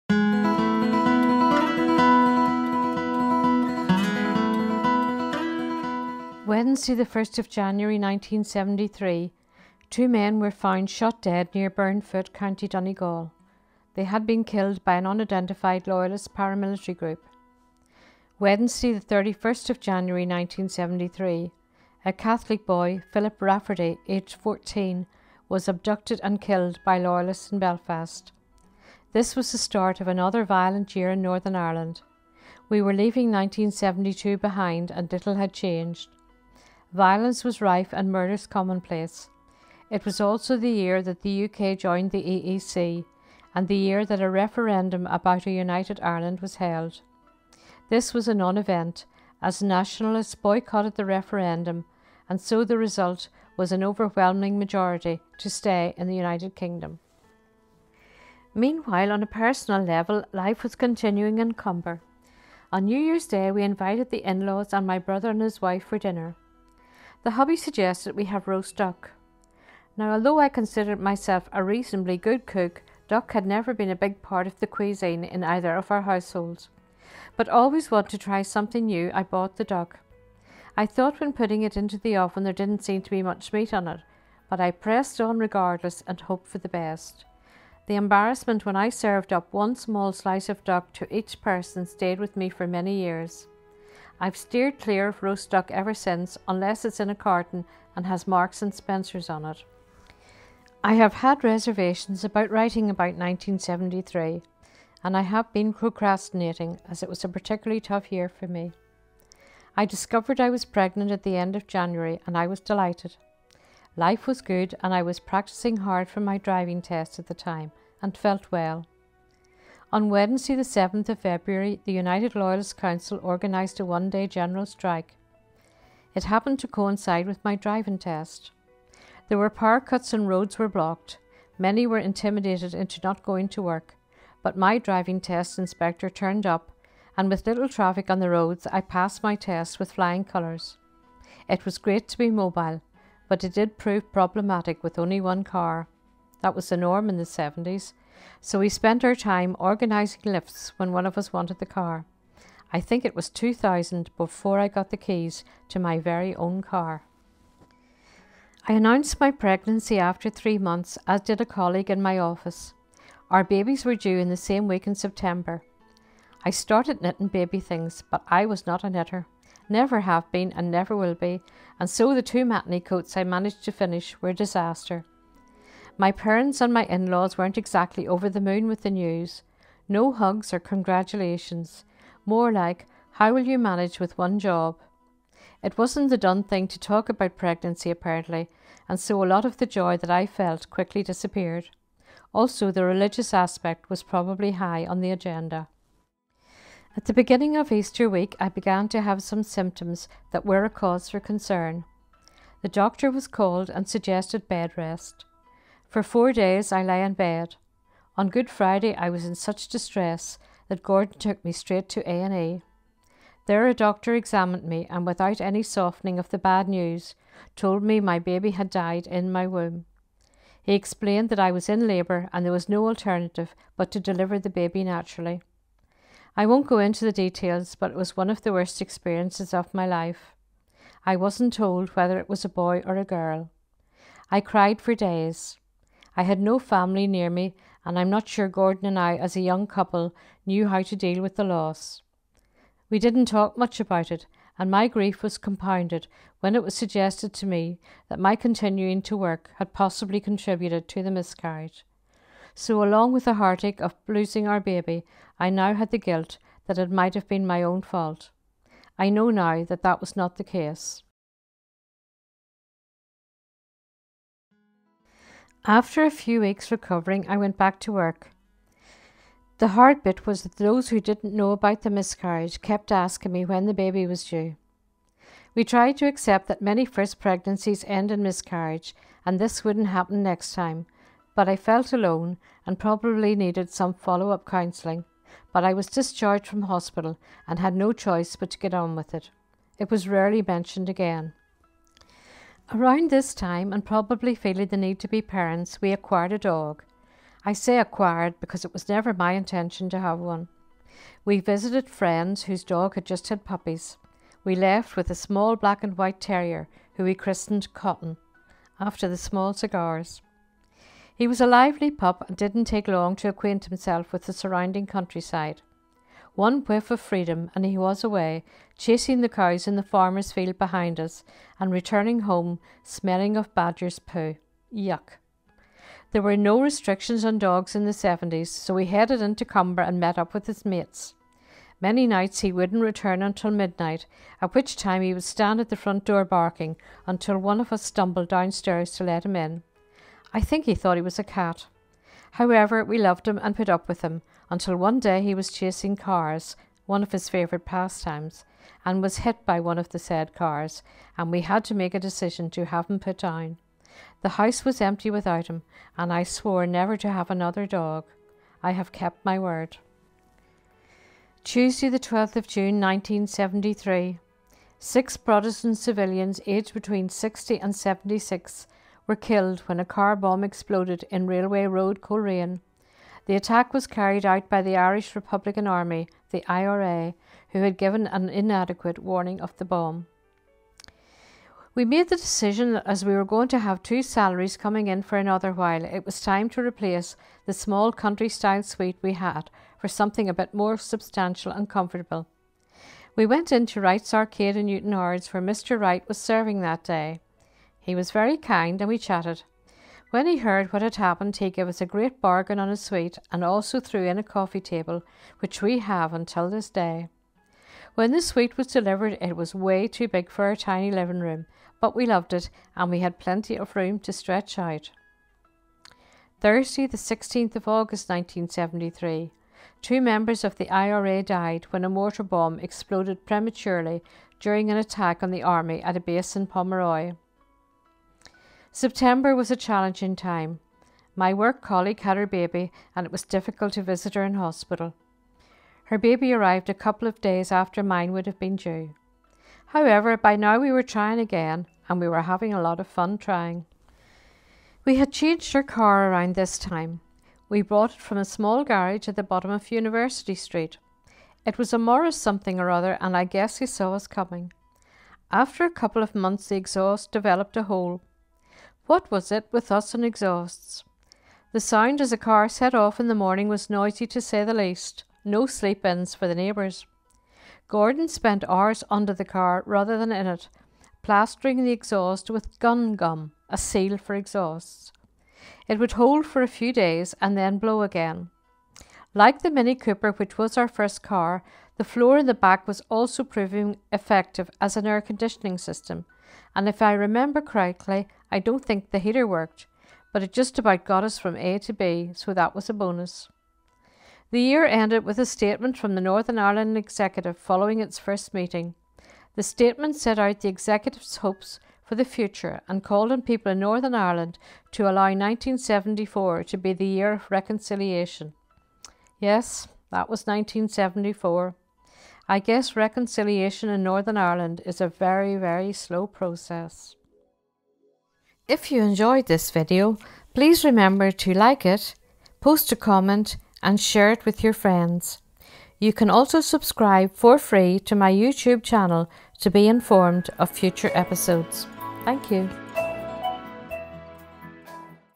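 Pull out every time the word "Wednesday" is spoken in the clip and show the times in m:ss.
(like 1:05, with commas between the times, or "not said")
0:06, 0:18, 2:00.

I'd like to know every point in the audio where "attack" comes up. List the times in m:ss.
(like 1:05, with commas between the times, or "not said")
6:13, 7:04.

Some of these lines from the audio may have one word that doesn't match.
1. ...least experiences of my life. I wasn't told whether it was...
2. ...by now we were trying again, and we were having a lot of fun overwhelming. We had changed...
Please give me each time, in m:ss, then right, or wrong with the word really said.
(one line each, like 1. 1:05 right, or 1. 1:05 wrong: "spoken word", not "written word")
1. 3:48 wrong: "worst", not "least"
2. 7:20 wrong: "trying", not "overwhelming".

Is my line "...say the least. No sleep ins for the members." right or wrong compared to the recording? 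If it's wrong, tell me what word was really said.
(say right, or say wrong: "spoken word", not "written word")
wrong: "neighbours", not "members".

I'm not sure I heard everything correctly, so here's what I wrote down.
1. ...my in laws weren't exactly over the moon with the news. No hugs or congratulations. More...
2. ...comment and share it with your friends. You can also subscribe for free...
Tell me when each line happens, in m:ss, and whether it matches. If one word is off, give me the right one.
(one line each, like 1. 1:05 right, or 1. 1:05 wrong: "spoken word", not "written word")
1. 2:56 right
2. 8:42 right.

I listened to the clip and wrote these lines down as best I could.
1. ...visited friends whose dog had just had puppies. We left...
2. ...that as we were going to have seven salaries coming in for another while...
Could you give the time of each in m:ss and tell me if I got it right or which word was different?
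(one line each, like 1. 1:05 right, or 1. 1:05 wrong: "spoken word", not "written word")
1. 5:01 right
2. 6:22 wrong: "two", not "seven".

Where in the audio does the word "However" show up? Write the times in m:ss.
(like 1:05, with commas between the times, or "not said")
5:42, 7:19.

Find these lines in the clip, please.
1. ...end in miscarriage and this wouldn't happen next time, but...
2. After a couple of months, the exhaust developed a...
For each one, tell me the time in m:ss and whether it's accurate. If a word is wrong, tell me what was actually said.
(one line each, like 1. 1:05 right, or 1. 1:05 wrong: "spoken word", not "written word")
1. 4:37 right
2. 7:35 right.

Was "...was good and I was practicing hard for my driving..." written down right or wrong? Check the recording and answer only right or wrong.
right.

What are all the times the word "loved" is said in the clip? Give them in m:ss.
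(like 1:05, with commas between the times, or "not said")
5:42, 6:52.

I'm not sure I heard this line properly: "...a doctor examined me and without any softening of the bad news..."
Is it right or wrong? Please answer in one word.
right.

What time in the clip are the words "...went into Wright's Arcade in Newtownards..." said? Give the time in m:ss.
6:33.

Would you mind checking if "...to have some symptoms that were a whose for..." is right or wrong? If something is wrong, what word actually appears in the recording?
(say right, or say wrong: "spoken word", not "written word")
wrong: "cause", not "whose".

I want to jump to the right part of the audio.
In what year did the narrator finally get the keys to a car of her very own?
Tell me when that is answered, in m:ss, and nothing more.
2:33.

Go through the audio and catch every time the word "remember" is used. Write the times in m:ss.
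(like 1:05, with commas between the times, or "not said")
8:06, 8:40.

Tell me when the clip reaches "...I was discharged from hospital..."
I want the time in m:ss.
4:45.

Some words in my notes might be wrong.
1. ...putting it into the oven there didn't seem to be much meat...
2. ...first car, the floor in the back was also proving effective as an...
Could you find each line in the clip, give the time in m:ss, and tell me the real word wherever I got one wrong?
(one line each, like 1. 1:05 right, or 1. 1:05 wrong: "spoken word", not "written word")
1. 1:21 right
2. 8:00 right.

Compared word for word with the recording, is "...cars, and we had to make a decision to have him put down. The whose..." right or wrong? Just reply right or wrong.
wrong.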